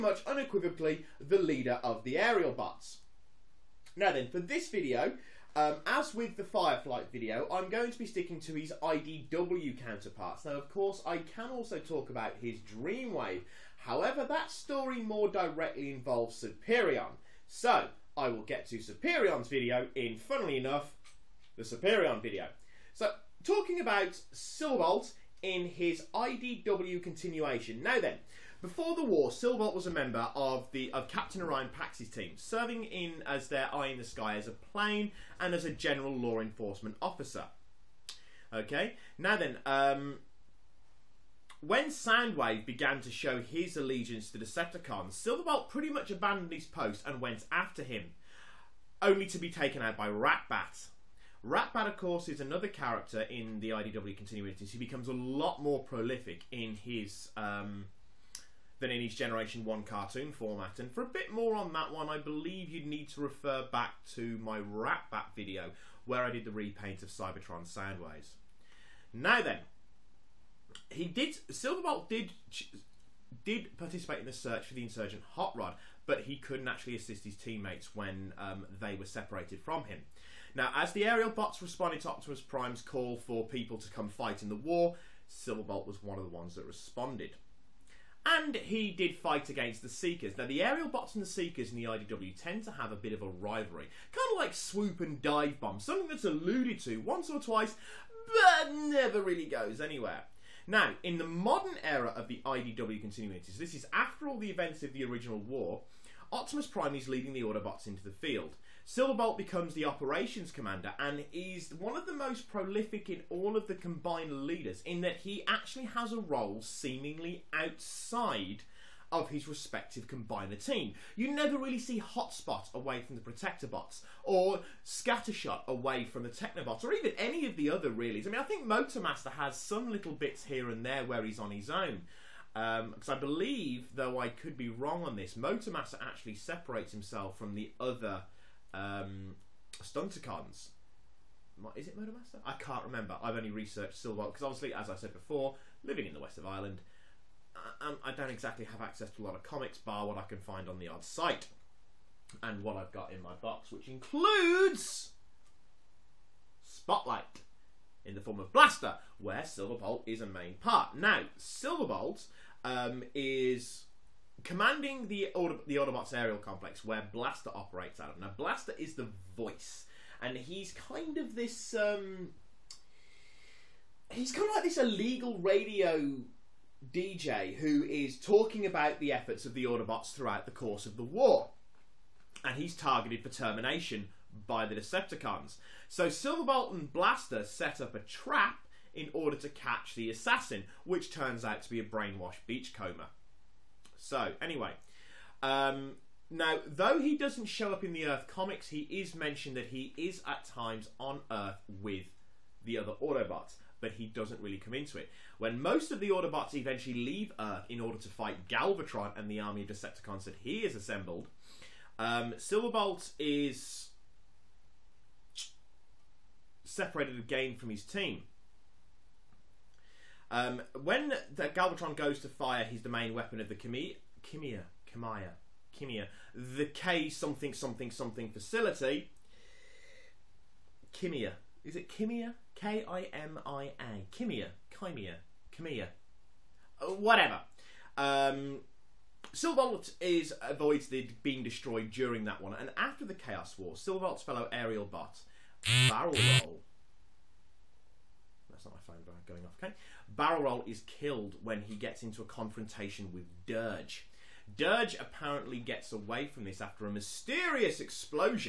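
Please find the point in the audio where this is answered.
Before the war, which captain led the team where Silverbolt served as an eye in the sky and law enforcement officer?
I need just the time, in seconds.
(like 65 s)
31 s.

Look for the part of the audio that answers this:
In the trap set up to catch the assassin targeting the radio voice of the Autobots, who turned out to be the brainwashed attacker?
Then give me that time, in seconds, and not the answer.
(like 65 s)
192 s.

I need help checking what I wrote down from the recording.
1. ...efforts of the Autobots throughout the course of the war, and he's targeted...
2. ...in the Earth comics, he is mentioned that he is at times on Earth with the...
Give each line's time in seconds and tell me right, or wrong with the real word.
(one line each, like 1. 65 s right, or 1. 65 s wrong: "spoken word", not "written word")
1. 179 s right
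2. 197 s right.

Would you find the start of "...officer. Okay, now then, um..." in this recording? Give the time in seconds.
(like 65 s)
37 s.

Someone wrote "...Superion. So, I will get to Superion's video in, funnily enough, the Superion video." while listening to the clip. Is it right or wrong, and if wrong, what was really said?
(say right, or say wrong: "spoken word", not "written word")
right.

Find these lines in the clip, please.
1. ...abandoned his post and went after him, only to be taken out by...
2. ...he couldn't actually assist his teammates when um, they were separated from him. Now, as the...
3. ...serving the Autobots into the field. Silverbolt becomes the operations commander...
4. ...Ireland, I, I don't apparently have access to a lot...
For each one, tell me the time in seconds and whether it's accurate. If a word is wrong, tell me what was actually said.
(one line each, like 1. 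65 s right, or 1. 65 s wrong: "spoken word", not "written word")
1. 46 s right
2. 76 s right
3. 107 s wrong: "leading", not "serving"
4. 146 s wrong: "exactly", not "apparently".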